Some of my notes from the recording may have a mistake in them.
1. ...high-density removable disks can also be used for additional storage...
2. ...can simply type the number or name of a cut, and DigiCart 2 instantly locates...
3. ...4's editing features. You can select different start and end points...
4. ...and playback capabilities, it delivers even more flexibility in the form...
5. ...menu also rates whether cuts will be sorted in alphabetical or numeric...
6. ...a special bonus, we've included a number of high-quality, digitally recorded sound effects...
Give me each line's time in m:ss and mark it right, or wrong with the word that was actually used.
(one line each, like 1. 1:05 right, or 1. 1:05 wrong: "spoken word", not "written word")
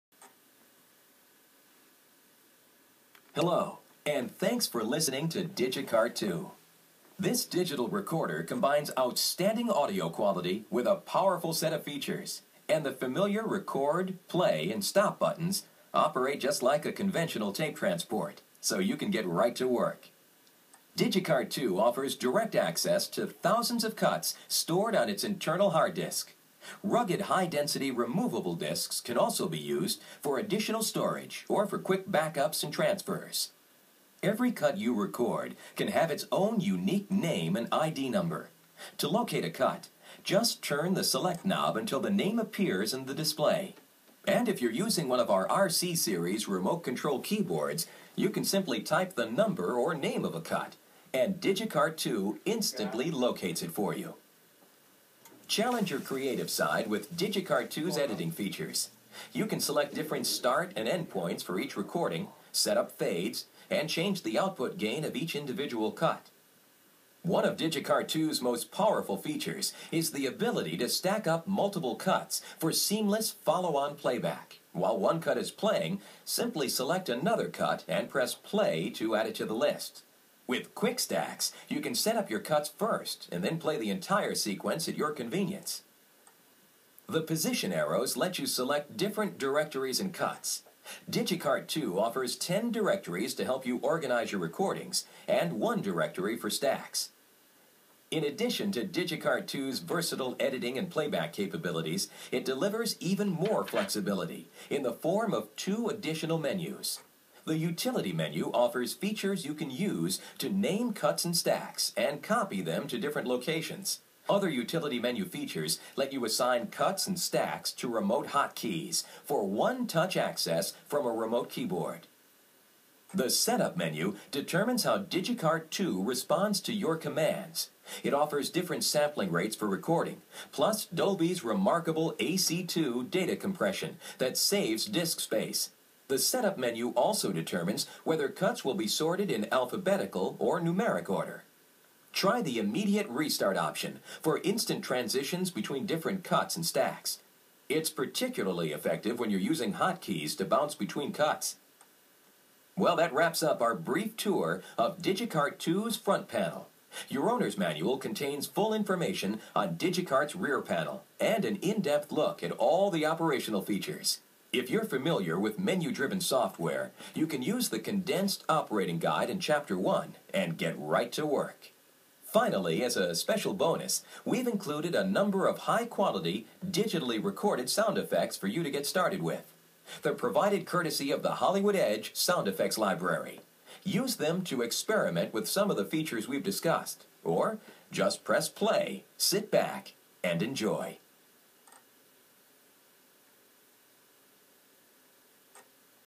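1. 0:27 right
2. 0:48 right
3. 0:57 wrong: "2", not "4"
4. 1:40 right
5. 2:16 wrong: "determines", not "rates"
6. 2:52 right.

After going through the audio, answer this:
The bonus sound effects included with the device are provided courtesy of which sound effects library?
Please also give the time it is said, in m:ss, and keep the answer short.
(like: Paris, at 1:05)
Hollywood Edge Sound Effects Library, at 3:01.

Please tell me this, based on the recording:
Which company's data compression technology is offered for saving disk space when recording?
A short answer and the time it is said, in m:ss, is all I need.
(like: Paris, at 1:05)
Dolby, at 2:10.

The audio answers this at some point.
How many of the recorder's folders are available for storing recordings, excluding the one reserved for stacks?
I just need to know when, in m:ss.
1:32.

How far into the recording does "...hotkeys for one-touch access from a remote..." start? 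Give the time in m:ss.
1:58.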